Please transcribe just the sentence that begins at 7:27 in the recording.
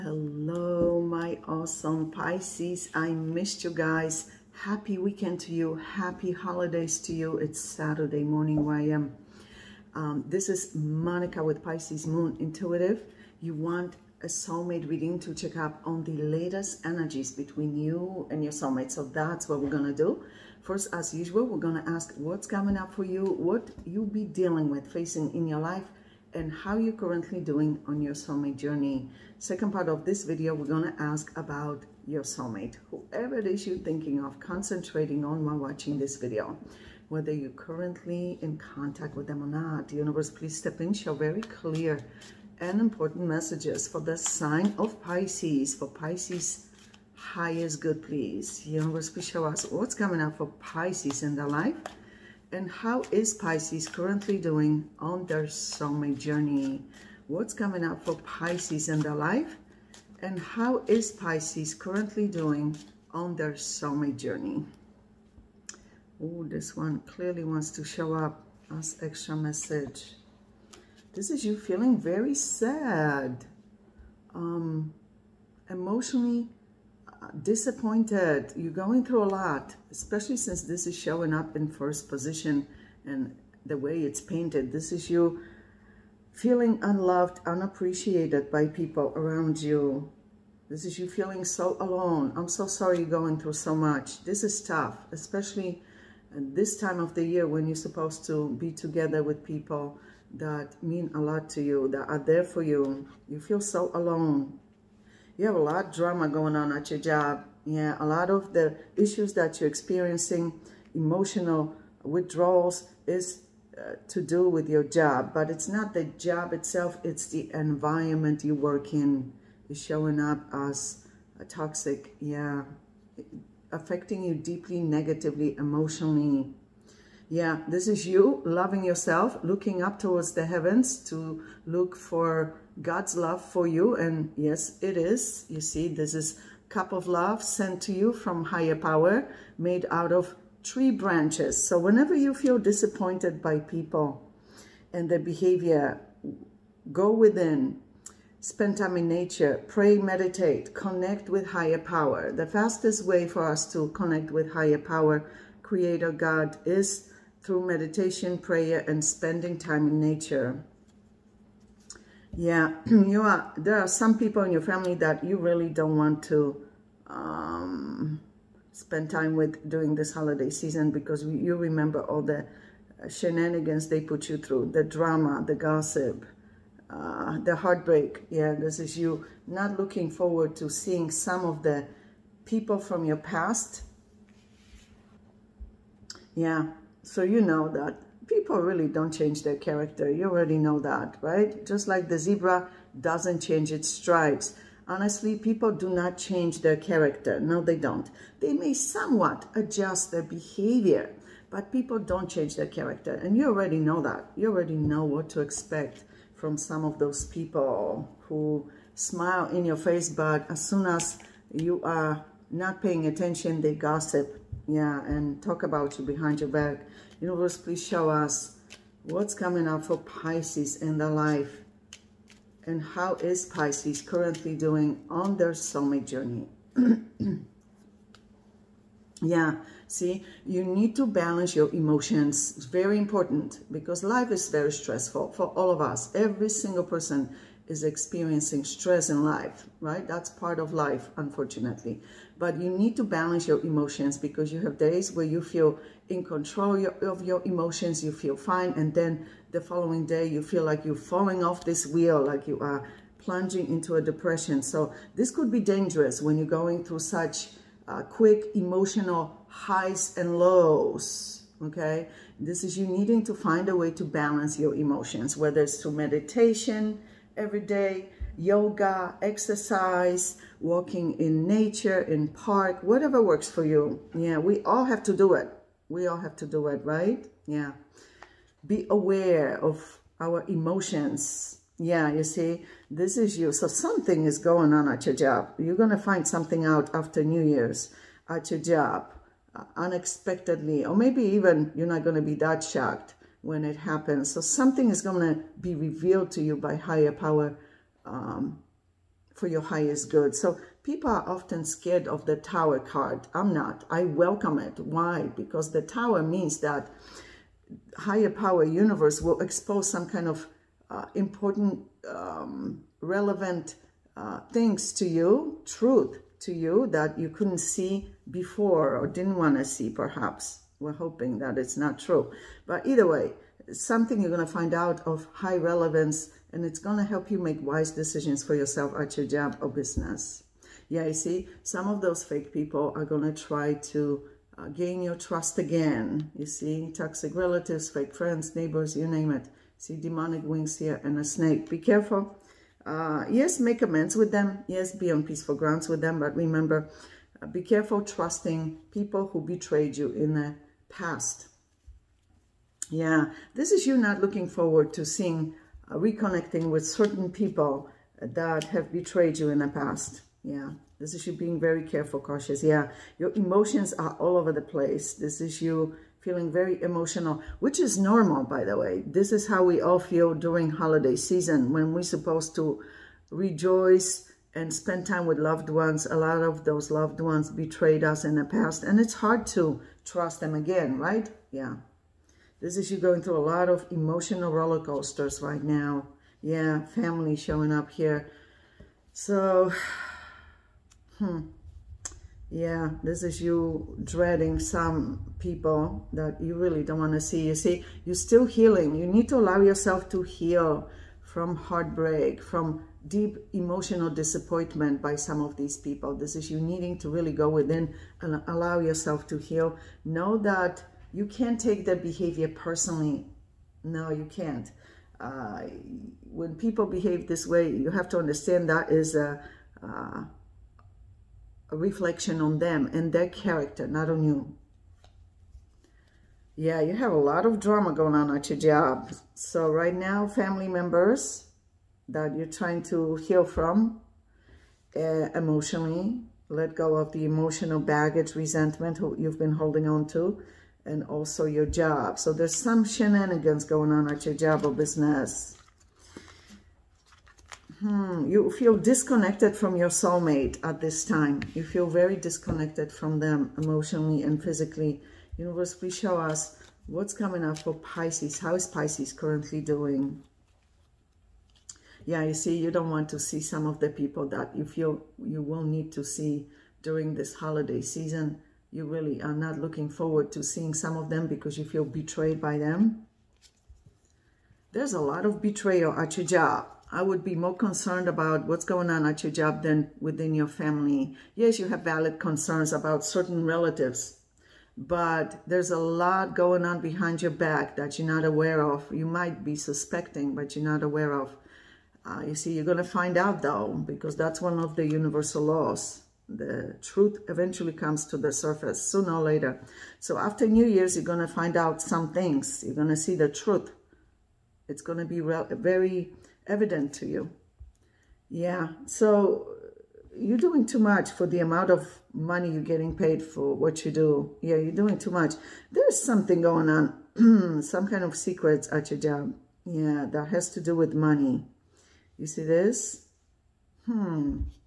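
Hmm, you feel disconnected from your soulmate at this time.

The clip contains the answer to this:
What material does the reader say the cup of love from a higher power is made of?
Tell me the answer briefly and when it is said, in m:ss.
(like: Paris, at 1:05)
tree branches, at 2:20.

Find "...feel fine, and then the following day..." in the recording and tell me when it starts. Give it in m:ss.
4:08.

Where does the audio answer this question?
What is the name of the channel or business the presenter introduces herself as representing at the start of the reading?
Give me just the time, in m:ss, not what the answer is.
0:11.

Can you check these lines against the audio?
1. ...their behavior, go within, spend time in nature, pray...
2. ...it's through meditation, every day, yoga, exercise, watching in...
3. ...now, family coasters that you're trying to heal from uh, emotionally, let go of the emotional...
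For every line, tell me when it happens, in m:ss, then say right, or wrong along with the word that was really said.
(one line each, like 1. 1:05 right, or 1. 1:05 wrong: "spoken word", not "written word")
1. 2:25 right
2. 4:25 wrong: "walking", not "watching"
3. 7:09 wrong: "members", not "coasters".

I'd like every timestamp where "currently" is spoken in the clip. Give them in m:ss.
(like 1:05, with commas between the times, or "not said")
0:26, 0:37, 0:53, 1:01, 3:44, 7:39.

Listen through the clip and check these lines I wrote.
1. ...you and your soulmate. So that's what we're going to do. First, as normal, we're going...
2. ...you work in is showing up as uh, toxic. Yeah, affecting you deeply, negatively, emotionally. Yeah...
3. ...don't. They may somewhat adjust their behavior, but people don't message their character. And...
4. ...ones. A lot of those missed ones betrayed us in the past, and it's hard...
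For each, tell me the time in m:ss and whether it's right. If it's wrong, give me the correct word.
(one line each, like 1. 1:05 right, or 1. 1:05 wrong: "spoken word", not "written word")
1. 0:17 wrong: "usual", not "normal"
2. 1:58 right
3. 3:17 wrong: "change", not "message"
4. 6:15 wrong: "loved", not "missed".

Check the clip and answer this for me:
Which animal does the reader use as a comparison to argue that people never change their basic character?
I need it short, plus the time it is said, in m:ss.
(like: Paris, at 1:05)
zebra, at 3:12.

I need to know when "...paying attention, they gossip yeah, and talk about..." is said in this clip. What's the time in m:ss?
3:32.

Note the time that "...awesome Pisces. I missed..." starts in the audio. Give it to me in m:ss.
0:01.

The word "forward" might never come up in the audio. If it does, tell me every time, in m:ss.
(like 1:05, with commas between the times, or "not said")
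3:00, 5:54, 7:49.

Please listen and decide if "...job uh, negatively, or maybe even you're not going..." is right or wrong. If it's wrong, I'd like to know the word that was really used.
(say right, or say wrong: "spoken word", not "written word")
wrong: "unexpectedly", not "negatively".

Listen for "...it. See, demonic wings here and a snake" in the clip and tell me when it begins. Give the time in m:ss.
5:39.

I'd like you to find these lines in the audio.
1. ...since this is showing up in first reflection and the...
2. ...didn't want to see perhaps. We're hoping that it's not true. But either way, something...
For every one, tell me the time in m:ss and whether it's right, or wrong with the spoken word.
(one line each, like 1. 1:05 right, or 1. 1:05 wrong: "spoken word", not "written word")
1. 1:20 wrong: "position", not "reflection"
2. 5:19 right.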